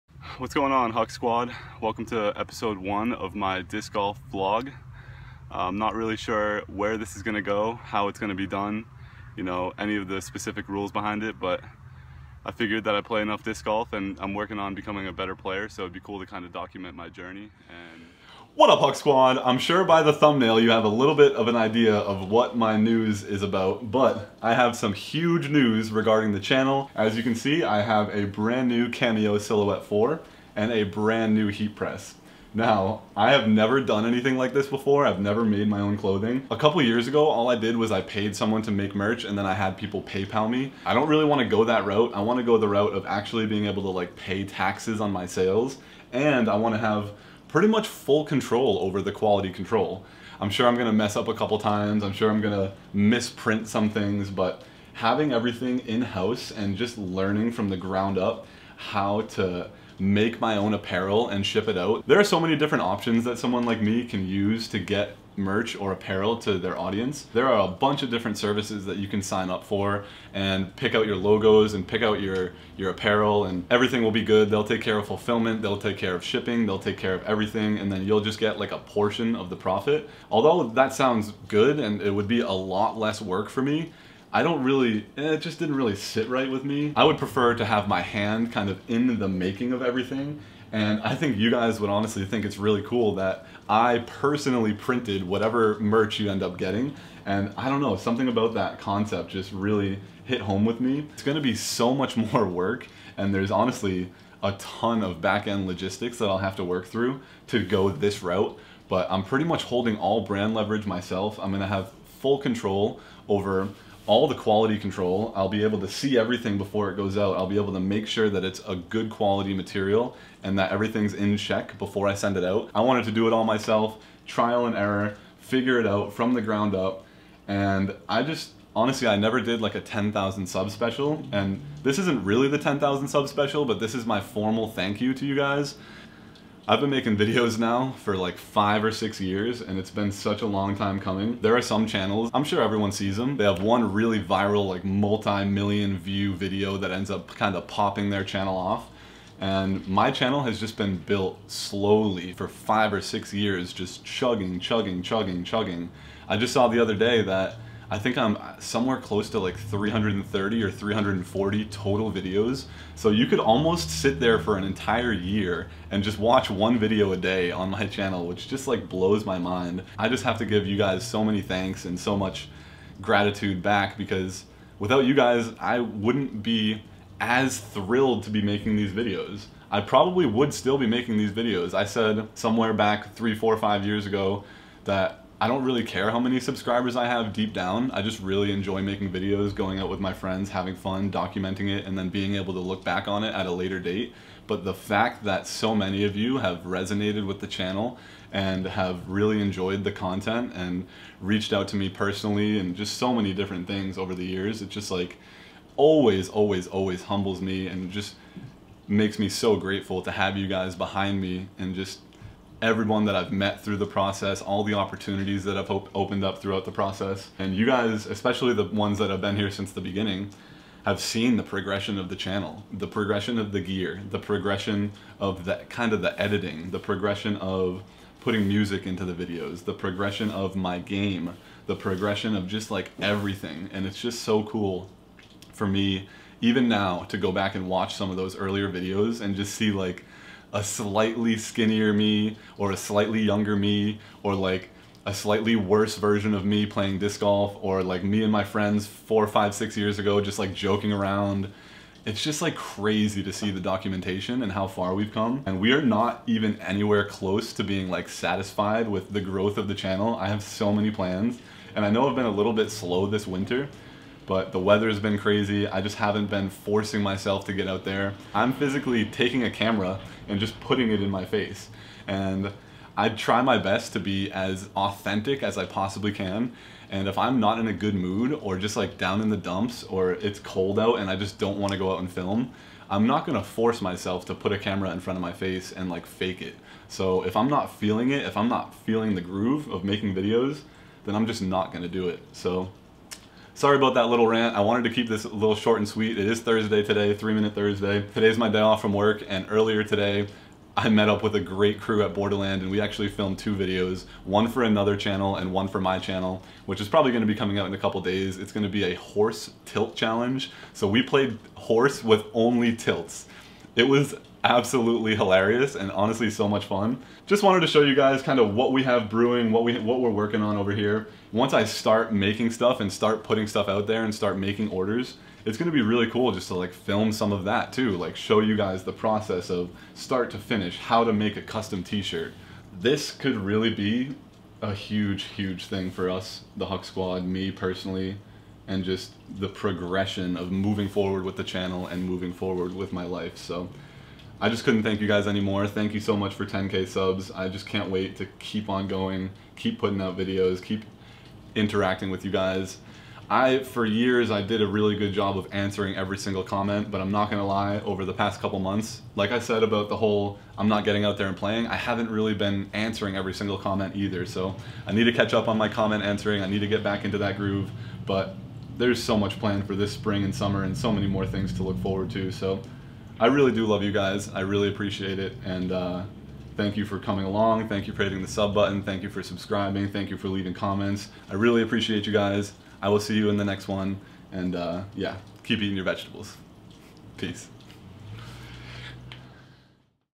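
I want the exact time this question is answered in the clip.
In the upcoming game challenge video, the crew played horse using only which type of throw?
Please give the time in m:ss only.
5:12.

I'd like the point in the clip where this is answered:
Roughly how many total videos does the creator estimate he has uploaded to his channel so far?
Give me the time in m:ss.
2:39.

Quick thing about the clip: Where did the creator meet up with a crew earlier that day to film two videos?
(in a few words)
Borderland.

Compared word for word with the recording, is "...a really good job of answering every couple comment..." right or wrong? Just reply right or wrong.
wrong.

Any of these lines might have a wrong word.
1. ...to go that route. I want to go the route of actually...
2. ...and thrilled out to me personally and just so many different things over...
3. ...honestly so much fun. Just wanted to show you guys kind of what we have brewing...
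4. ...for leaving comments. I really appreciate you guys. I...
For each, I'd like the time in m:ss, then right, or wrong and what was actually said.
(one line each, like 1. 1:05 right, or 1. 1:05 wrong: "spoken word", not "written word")
1. 0:41 right
2. 3:20 wrong: "reached", not "thrilled"
3. 5:15 right
4. 6:20 right.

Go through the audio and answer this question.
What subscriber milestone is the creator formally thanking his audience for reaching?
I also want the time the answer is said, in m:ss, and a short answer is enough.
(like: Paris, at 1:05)
10k, at 5:46.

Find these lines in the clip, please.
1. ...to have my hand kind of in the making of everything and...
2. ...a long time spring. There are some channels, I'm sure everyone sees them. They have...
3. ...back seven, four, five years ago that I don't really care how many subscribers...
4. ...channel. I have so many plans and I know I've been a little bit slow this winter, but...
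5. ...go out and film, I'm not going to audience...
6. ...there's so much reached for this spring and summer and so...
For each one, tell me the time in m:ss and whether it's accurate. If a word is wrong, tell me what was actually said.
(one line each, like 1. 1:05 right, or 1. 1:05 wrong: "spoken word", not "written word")
1. 1:27 right
2. 2:20 wrong: "coming", not "spring"
3. 3:02 wrong: "three", not "seven"
4. 4:19 right
5. 4:41 wrong: "force", not "audience"
6. 6:08 wrong: "planned", not "reached".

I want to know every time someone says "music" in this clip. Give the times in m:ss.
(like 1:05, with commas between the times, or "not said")
3:48.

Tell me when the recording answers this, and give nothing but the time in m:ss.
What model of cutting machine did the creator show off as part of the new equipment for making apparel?
0:28.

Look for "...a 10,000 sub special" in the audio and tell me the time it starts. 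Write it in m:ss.
2:09.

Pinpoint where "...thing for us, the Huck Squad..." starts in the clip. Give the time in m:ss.
5:35.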